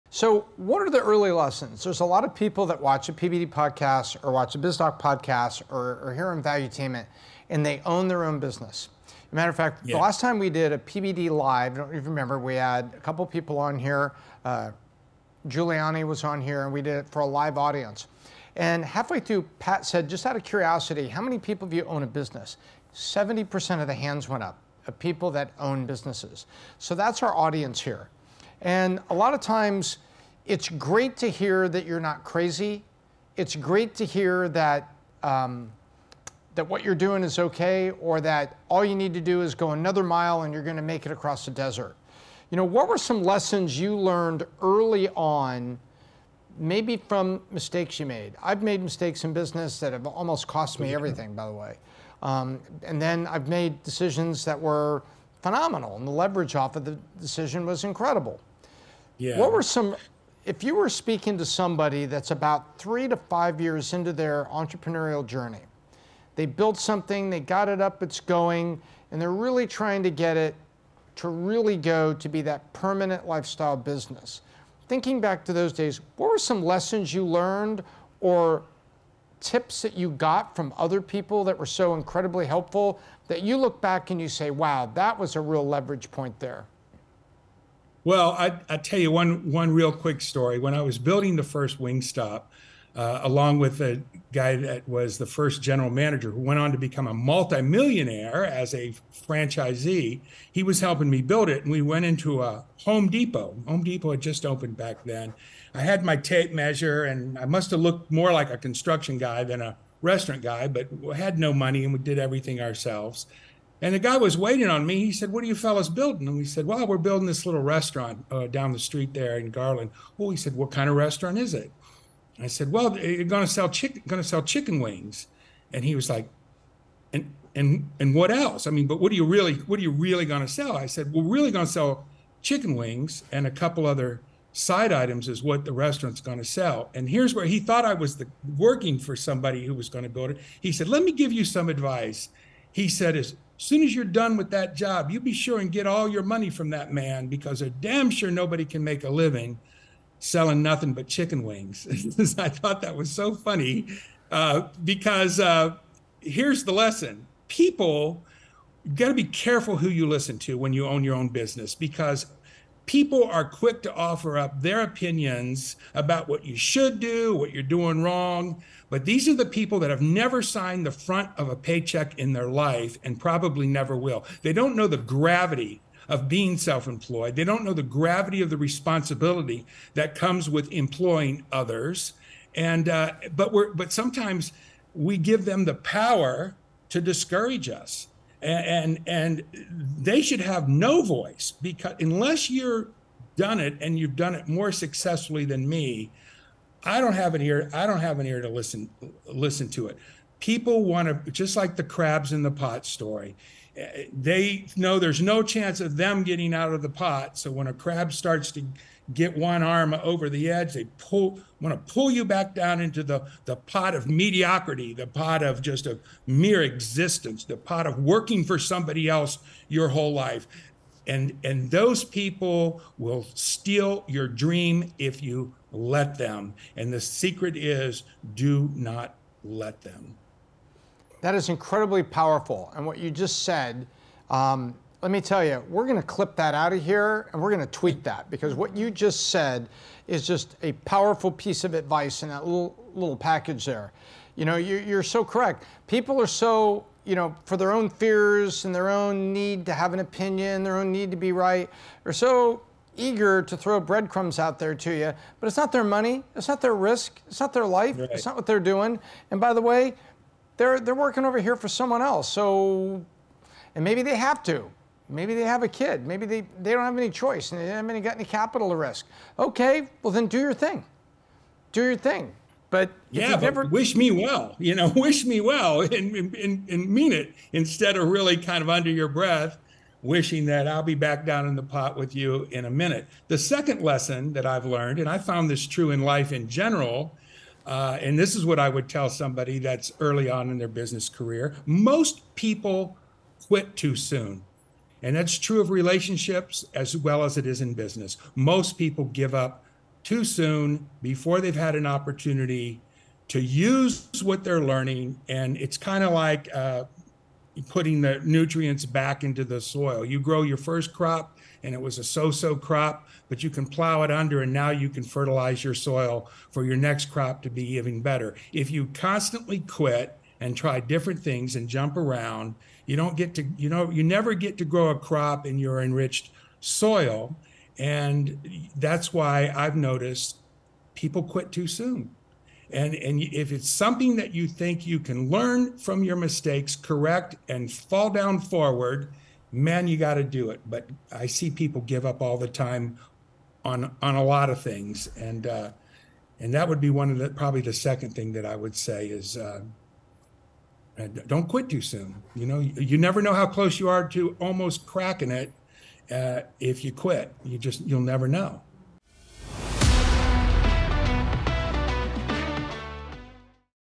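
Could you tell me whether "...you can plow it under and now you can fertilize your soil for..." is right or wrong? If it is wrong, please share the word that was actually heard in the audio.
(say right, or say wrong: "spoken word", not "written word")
right.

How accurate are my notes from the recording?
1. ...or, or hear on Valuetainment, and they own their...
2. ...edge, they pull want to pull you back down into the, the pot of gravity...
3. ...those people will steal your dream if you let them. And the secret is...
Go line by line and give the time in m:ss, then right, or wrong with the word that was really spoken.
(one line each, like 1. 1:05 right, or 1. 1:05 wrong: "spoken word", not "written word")
1. 0:05 right
2. 3:30 wrong: "mediocrity", not "gravity"
3. 3:41 right.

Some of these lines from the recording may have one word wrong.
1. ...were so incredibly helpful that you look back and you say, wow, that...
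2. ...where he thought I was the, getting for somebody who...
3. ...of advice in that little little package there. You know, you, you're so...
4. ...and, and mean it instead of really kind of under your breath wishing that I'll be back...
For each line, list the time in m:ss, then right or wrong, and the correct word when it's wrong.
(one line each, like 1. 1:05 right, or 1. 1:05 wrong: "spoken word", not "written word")
1. 1:21 right
2. 2:17 wrong: "working", not "getting"
3. 4:01 right
4. 4:36 right.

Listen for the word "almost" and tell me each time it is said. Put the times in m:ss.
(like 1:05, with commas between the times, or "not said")
0:50, 5:54.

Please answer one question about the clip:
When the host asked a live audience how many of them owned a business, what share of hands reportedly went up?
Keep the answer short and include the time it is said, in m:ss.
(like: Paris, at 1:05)
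70%, at 0:22.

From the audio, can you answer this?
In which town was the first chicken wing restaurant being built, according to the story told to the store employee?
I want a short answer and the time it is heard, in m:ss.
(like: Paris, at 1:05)
Garland, at 1:59.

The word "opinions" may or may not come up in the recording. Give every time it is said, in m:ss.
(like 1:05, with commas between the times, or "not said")
2:44, 4:10.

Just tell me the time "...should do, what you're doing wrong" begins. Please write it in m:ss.
2:46.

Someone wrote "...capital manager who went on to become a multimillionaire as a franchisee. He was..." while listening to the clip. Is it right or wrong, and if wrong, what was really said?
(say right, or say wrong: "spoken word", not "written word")
wrong: "general", not "capital".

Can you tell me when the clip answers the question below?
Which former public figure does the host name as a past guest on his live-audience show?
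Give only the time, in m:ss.
0:15.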